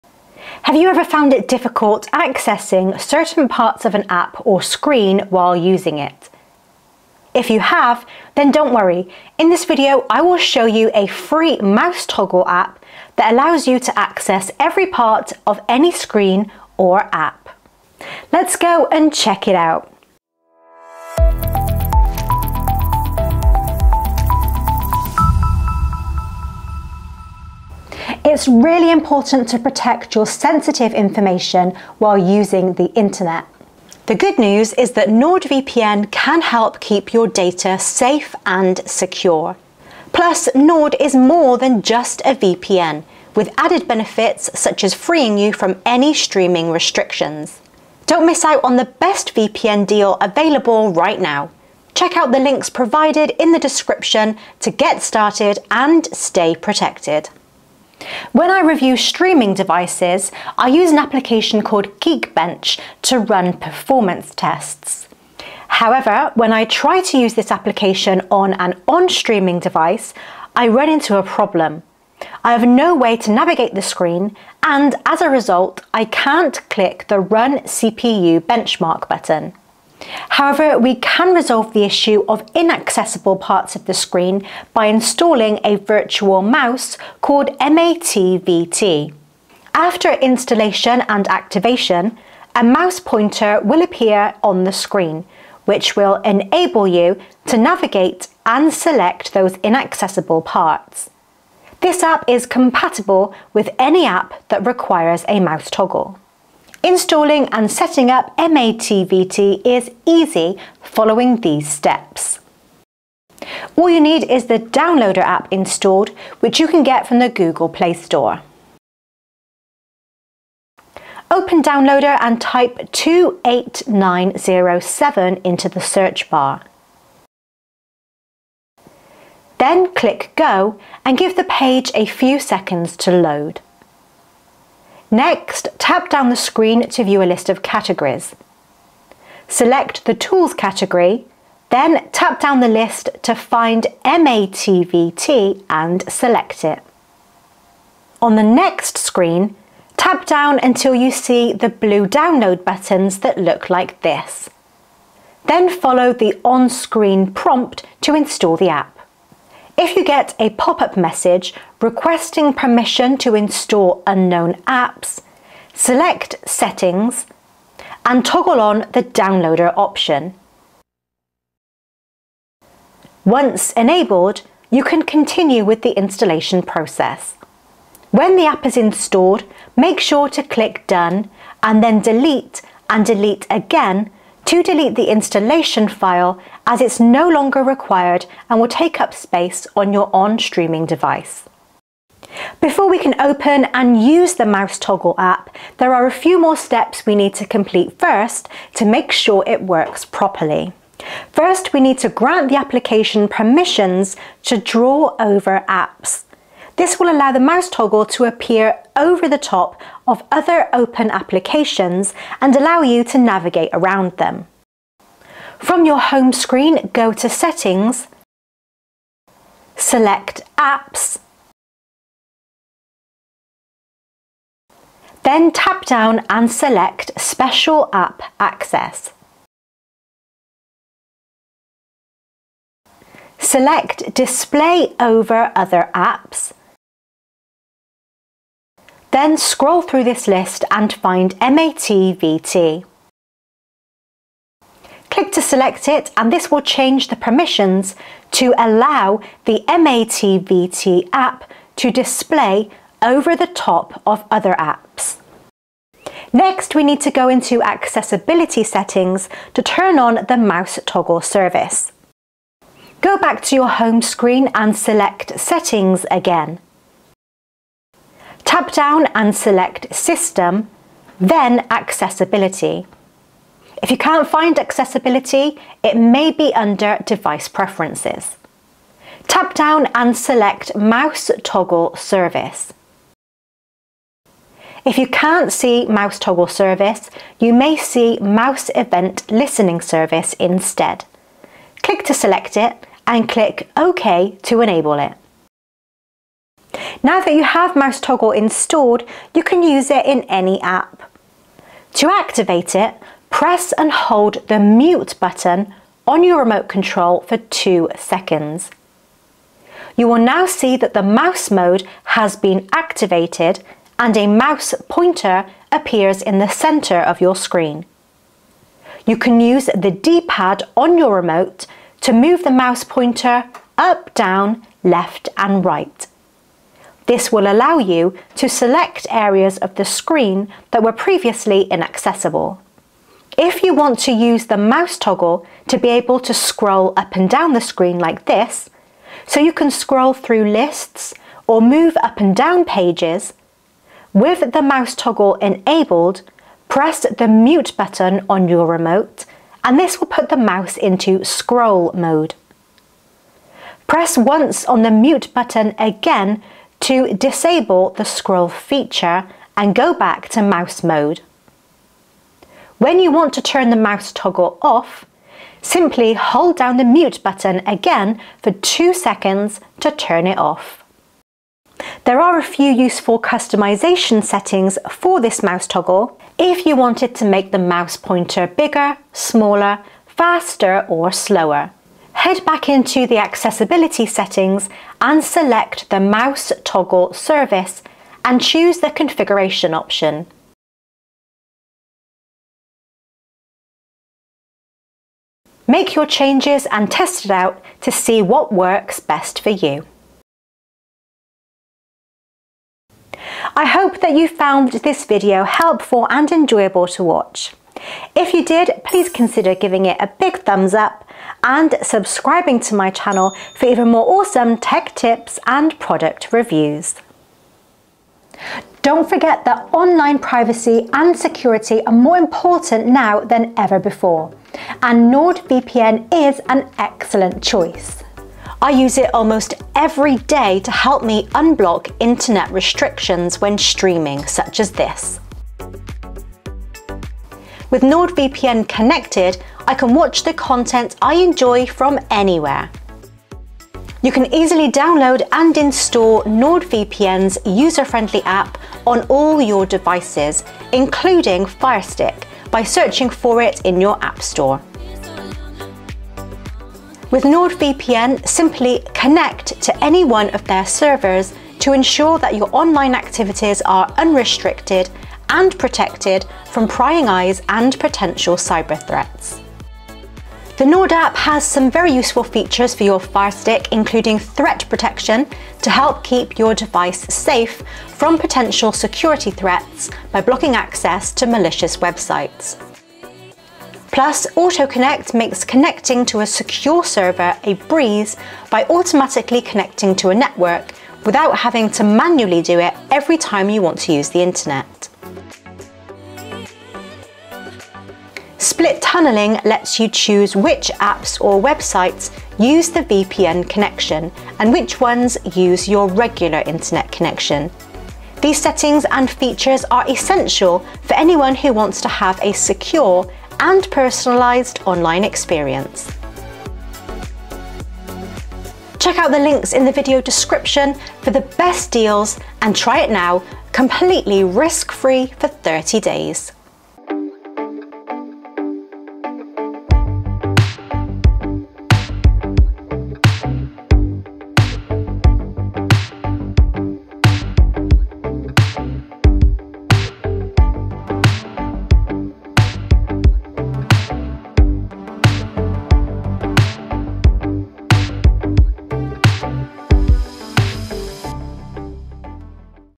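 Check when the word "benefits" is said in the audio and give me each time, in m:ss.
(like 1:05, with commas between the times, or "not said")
0:43.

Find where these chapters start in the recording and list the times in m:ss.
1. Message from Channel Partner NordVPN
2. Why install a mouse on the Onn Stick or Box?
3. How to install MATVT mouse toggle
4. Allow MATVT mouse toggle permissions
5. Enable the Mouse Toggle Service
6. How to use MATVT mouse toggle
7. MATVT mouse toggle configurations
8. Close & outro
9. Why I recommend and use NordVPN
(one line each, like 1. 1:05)
1. 0:28
2. 0:58
3. 1:46
4. 3:12
5. 4:16
6. 4:57
7. 6:12
8. 6:43
9. 6:58.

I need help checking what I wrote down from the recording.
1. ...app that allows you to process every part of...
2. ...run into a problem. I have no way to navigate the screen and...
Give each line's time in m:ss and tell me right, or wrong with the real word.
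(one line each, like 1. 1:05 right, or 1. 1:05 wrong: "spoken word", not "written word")
1. 0:12 wrong: "access", not "process"
2. 1:10 right.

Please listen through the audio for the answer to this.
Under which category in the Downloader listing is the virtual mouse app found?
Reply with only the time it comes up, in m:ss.
2:20.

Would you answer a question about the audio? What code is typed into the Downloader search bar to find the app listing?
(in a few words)
28907.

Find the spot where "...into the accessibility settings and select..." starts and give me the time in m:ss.
6:22.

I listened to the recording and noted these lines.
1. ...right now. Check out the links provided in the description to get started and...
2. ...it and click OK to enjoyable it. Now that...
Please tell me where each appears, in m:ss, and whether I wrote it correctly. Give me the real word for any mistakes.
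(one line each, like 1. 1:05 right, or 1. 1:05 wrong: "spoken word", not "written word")
1. 0:50 right
2. 4:52 wrong: "enable", not "enjoyable".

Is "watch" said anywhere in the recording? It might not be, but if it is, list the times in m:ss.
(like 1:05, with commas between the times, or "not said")
6:47, 7:19.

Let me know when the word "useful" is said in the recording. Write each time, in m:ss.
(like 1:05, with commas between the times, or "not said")
6:12, 7:51.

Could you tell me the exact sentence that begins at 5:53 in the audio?
Press once on the mute button again to disable the scroll feature and go back to mouse mode.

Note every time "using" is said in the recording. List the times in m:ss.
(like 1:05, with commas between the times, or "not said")
0:05, 0:32.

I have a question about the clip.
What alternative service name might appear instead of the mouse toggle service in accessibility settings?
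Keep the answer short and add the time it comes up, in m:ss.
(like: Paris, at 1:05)
Mouse Event Listening Service, at 4:48.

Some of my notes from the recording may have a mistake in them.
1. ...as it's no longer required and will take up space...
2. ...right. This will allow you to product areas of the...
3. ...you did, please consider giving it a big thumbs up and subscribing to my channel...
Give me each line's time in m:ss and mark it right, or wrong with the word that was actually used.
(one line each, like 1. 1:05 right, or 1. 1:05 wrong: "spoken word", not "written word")
1. 3:06 right
2. 5:25 wrong: "select", not "product"
3. 6:48 right.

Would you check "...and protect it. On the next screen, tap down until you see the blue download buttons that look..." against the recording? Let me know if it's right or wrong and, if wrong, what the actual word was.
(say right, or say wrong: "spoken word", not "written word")
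wrong: "select", not "protect".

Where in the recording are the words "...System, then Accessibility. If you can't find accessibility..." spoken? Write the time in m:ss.
4:29.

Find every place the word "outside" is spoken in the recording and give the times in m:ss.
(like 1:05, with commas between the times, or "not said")
not said.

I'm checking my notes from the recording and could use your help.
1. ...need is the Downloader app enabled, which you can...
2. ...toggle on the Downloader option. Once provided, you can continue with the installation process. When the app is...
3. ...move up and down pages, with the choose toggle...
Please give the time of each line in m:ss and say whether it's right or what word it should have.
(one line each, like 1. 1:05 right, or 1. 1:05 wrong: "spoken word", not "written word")
1. 1:54 wrong: "installed", not "enabled"
2. 2:48 wrong: "enabled", not "provided"
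3. 5:41 wrong: "mouse", not "choose".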